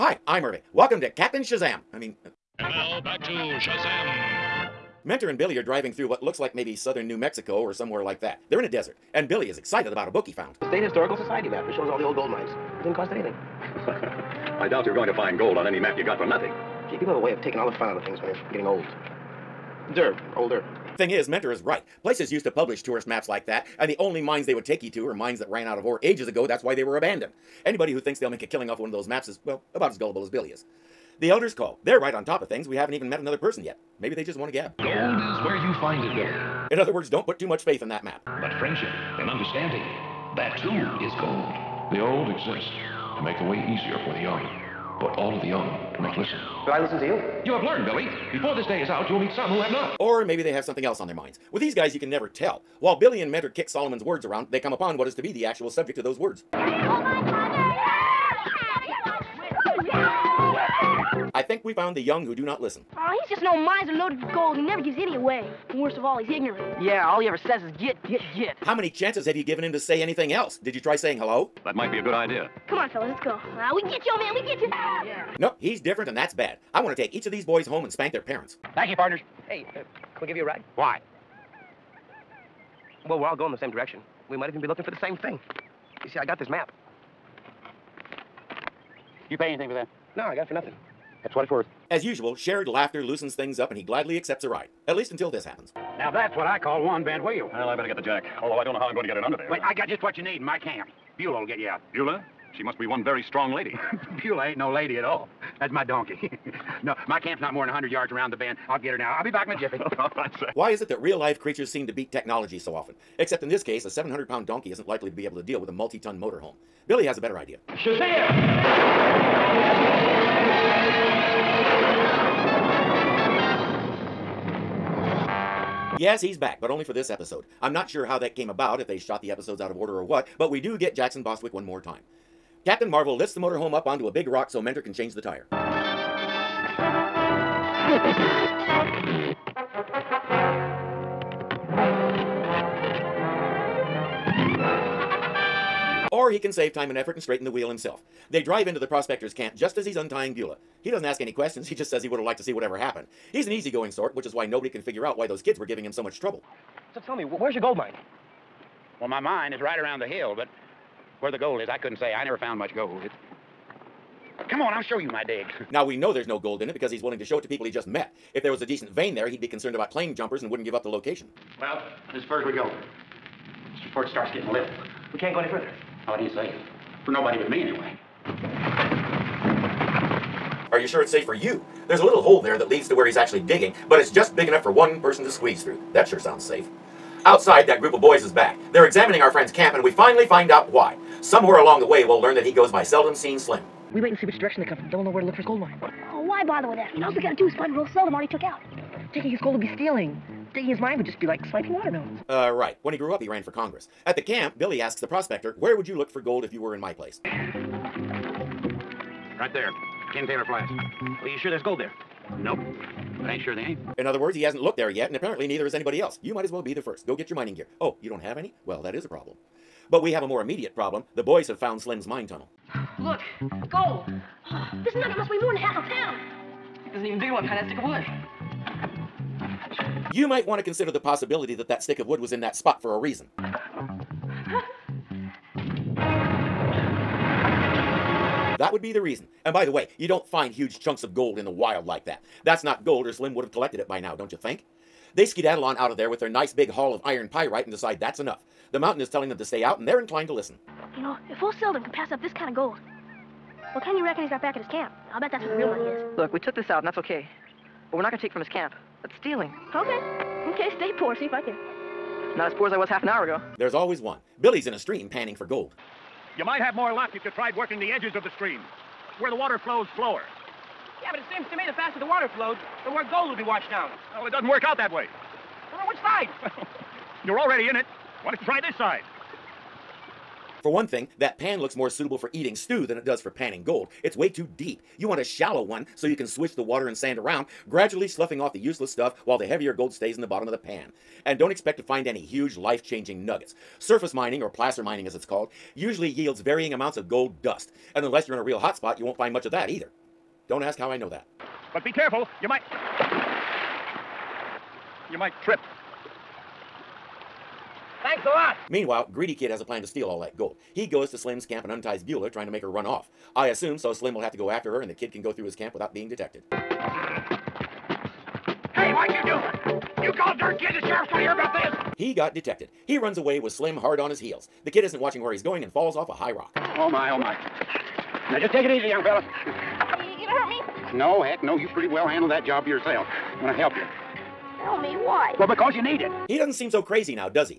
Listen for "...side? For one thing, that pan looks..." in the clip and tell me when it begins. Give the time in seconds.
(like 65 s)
278 s.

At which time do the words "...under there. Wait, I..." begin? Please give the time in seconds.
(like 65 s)
99 s.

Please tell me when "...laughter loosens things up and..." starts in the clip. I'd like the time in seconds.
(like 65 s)
92 s.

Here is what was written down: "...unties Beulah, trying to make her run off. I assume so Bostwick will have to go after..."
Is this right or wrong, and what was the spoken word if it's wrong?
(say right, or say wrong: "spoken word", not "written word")
wrong: "Slim", not "Bostwick".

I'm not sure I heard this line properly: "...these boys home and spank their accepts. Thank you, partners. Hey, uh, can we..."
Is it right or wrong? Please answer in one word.
wrong.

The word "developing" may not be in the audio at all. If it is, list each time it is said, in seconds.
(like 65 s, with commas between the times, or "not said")
not said.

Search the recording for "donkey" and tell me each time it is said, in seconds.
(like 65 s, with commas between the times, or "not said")
105 s, 114 s.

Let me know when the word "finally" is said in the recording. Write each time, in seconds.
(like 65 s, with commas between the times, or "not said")
189 s.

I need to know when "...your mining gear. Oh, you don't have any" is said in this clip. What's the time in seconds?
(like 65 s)
217 s.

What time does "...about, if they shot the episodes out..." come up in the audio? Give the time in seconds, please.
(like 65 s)
128 s.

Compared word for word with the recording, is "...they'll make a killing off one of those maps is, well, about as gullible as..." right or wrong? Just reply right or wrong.
right.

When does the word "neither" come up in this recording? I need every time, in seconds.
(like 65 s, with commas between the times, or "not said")
215 s.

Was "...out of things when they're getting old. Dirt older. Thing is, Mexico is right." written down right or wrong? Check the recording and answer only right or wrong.
wrong.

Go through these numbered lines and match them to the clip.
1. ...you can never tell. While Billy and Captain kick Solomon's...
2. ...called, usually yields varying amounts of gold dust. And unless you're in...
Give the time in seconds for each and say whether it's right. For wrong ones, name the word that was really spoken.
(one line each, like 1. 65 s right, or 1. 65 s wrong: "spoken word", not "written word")
1. 51 s wrong: "Mentor", not "Captain"
2. 295 s right.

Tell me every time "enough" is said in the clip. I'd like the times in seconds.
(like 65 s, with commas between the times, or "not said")
184 s, 248 s.